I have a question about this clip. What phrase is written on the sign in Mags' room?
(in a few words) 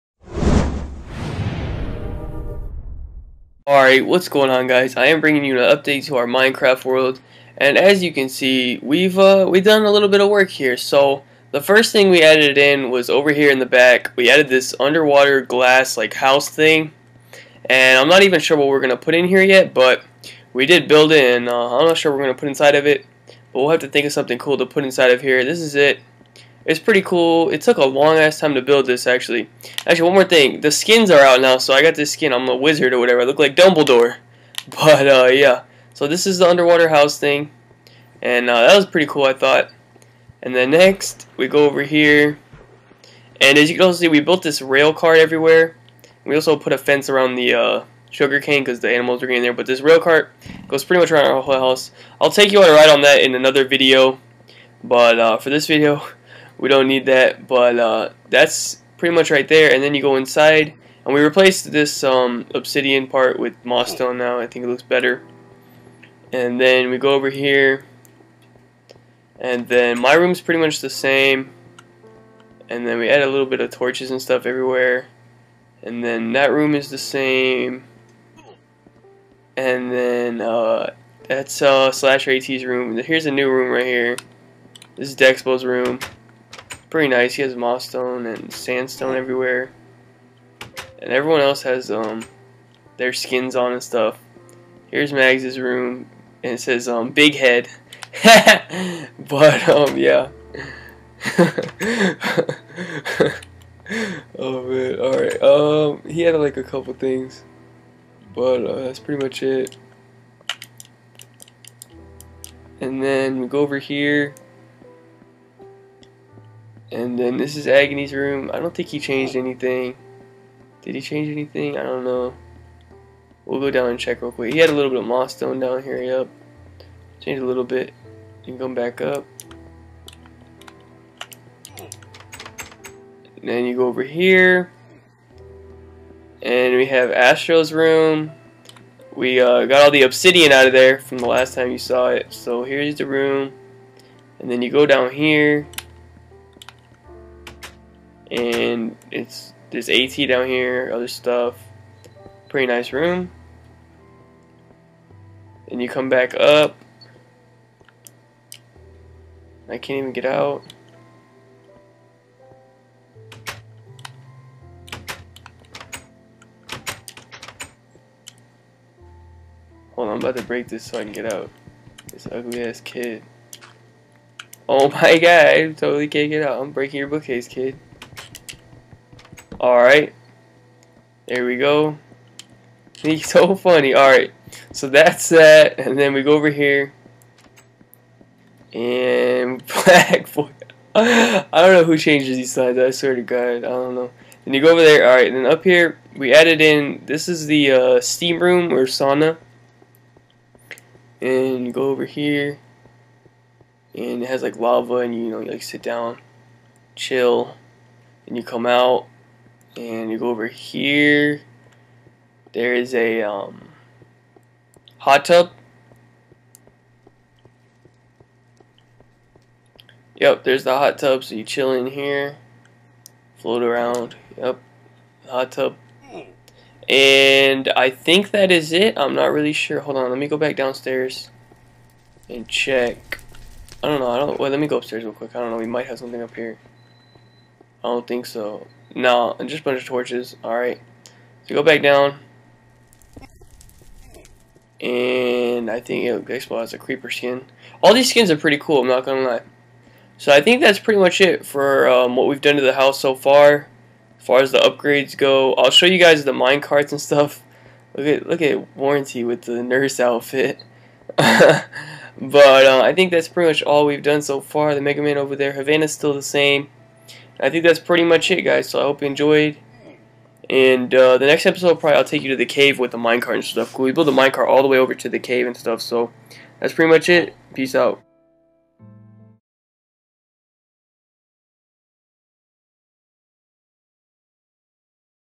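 Big head.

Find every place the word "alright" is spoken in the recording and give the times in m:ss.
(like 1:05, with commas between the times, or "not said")
0:03, 1:44, 2:59, 3:03, 3:15, 4:00.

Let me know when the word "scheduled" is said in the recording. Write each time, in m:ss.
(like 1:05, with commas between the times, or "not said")
not said.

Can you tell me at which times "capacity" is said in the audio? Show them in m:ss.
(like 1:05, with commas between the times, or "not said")
not said.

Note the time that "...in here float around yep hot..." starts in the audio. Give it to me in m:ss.
3:41.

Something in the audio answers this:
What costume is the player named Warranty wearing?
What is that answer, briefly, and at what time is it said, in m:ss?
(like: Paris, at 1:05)
Nurse outfit, at 4:19.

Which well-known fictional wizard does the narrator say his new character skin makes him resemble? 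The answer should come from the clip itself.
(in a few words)
Dumbledore.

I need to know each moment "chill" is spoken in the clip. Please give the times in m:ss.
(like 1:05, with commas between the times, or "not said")
3:26, 3:41.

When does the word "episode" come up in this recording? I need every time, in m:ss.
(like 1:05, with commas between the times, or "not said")
4:31.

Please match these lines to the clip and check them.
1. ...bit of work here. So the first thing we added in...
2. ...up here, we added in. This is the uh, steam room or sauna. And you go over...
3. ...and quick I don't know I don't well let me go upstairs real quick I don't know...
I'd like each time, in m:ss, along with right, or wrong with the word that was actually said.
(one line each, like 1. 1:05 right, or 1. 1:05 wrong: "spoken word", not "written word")
1. 0:10 right
2. 3:15 right
3. 3:52 wrong: "check", not "quick".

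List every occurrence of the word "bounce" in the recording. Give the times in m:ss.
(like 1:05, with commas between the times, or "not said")
not said.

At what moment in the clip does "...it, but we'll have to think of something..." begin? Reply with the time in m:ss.
0:22.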